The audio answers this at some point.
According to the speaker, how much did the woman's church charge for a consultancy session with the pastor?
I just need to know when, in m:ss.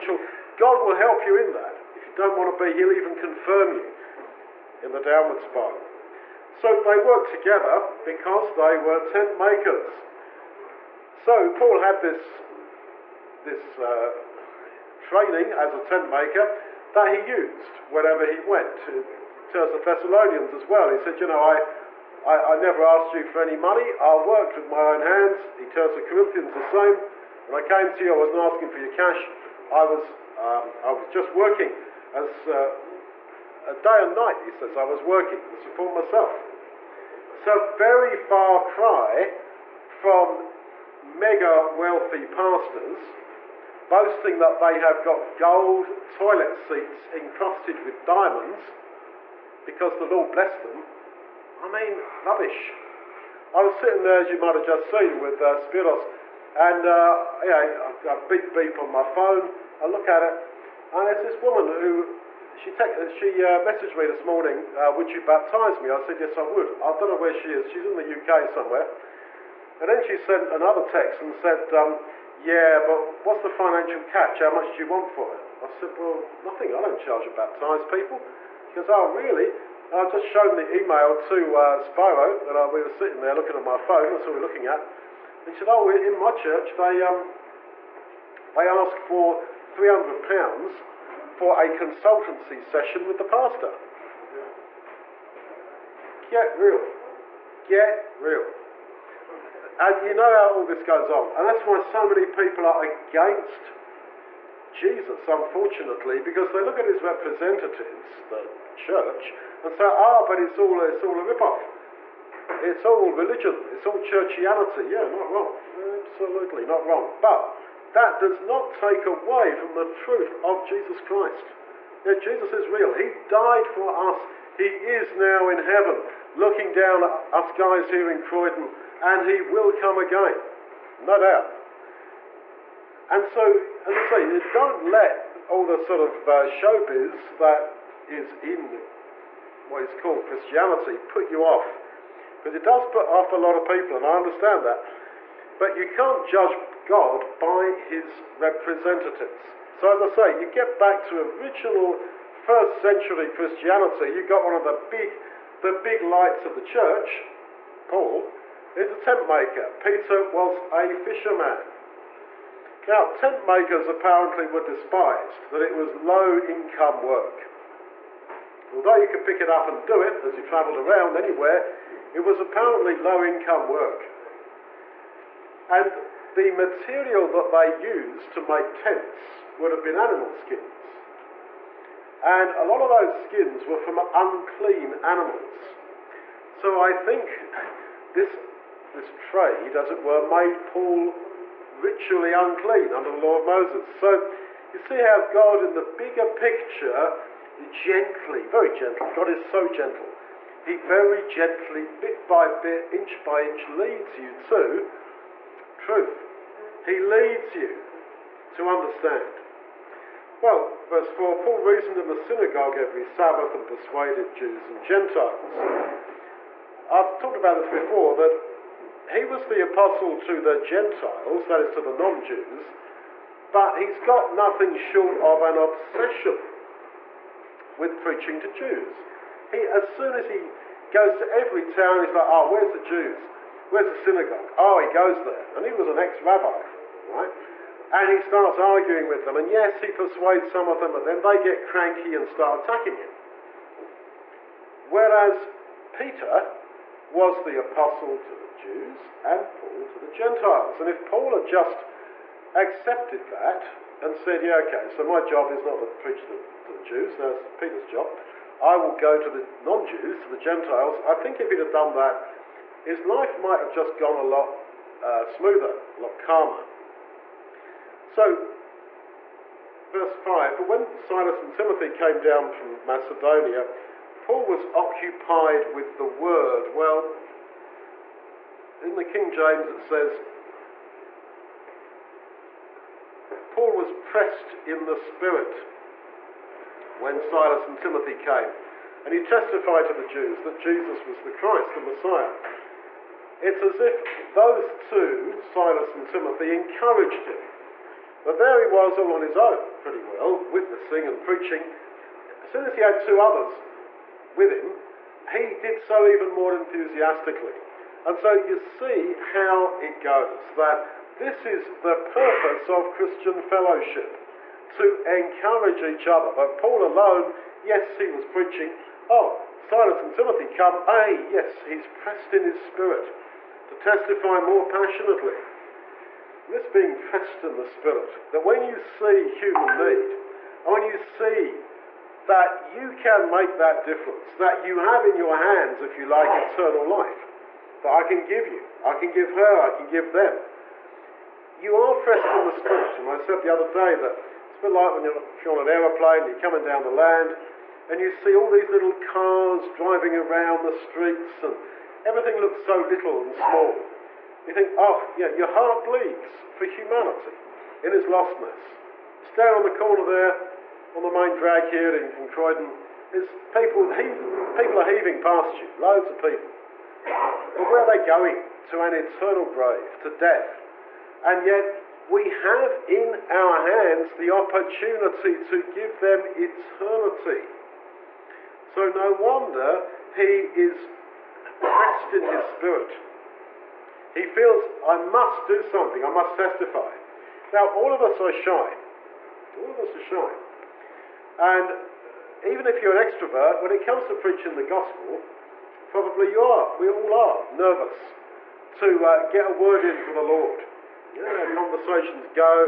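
1:29.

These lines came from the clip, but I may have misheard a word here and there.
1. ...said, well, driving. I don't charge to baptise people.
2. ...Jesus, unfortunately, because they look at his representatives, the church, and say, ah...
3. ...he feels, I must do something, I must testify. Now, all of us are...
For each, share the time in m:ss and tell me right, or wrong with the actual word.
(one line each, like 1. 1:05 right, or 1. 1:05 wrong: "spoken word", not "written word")
1. 1:15 wrong: "nothing", not "driving"
2. 1:44 right
3. 6:24 right.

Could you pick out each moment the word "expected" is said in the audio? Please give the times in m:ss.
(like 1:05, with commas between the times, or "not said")
not said.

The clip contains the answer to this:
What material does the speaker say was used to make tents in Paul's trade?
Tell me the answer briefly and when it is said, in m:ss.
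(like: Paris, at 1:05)
animal skins, at 2:59.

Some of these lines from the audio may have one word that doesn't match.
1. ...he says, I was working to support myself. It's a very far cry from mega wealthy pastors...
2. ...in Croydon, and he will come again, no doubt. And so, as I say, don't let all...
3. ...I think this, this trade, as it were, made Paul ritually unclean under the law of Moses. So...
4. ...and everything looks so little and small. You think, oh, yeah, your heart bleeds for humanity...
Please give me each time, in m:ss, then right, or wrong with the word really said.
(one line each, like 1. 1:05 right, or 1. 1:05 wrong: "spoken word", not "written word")
1. 0:34 right
2. 2:08 right
3. 3:06 right
4. 5:51 right.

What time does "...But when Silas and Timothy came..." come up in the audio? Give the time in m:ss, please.
4:30.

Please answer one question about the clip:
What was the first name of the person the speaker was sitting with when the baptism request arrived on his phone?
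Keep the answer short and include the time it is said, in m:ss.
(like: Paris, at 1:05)
Spiros, at 0:55.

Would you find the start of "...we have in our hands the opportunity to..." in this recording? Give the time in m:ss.
6:12.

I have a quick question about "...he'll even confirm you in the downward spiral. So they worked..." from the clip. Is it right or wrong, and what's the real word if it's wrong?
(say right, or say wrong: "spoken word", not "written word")
right.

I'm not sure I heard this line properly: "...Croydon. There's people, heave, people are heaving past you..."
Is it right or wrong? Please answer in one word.
right.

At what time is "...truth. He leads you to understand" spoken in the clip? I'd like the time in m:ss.
3:25.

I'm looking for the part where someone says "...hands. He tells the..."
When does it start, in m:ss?
0:24.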